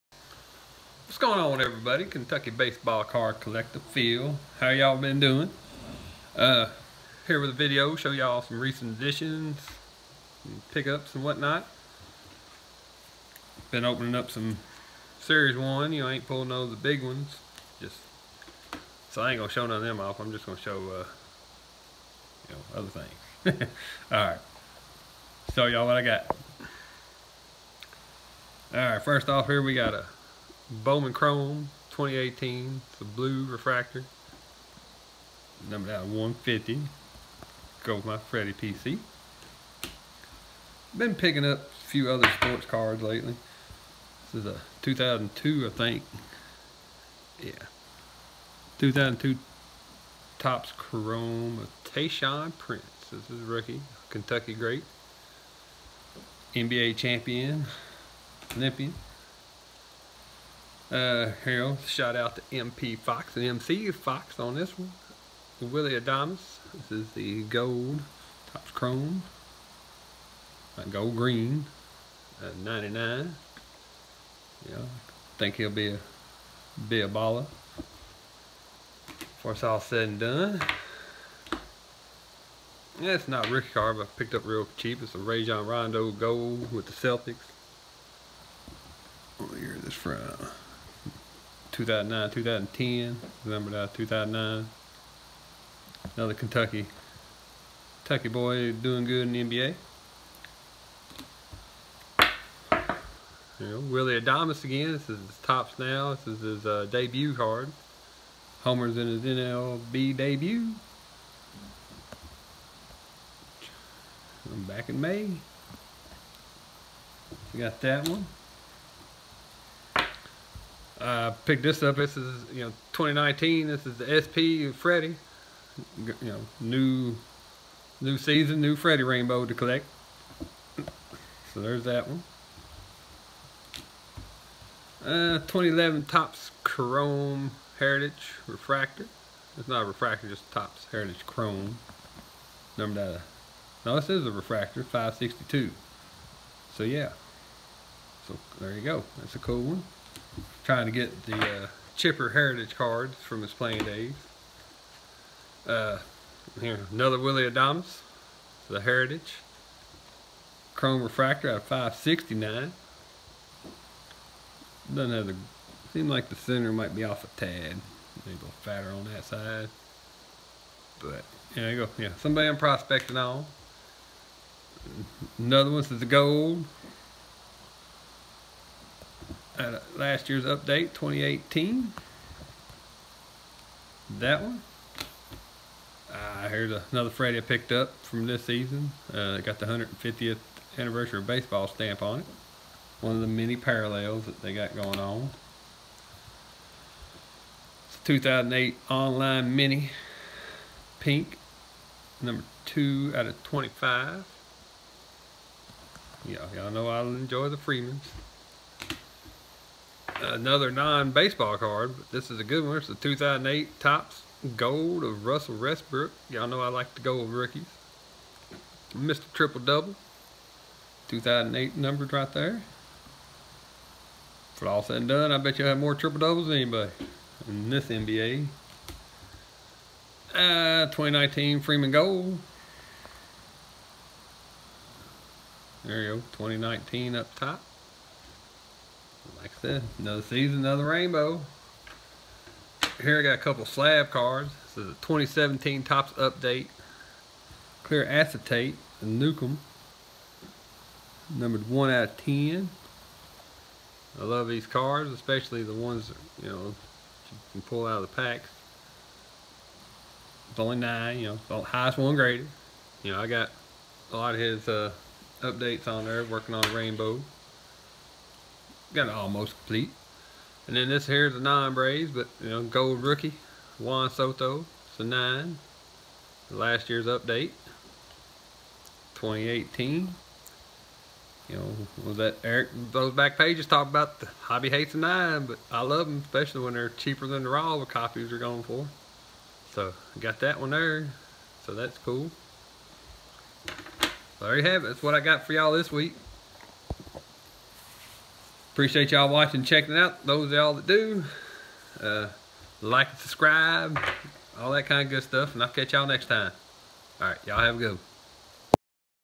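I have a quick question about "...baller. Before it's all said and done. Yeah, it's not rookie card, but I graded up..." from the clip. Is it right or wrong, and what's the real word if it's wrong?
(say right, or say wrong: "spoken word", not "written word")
wrong: "picked", not "graded".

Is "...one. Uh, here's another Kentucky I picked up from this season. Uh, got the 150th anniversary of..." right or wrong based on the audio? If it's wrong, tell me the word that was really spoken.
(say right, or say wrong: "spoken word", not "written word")
wrong: "Freddy", not "Kentucky".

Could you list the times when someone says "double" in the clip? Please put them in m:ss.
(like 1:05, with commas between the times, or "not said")
3:39, 3:46.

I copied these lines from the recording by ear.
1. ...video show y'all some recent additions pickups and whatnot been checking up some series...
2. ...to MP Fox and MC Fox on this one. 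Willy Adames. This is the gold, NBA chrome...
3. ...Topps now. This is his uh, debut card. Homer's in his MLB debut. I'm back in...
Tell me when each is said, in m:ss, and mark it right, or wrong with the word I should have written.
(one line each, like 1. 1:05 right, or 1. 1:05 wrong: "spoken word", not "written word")
1. 0:07 wrong: "opening", not "checking"
2. 1:02 wrong: "Topps", not "NBA"
3. 1:45 right.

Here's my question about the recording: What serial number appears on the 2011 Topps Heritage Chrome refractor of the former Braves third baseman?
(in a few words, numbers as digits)
562.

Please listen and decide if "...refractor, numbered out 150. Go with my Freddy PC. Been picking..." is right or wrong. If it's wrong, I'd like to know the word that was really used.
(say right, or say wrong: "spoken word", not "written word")
right.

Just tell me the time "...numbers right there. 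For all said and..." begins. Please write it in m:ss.
3:41.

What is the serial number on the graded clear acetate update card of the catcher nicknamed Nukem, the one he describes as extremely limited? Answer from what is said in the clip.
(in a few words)
1 of 10.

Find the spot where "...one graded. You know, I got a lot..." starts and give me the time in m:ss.
4:21.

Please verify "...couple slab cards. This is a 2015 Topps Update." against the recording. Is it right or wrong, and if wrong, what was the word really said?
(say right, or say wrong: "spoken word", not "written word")
wrong: "2017", not "2015".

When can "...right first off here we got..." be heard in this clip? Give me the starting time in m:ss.
0:28.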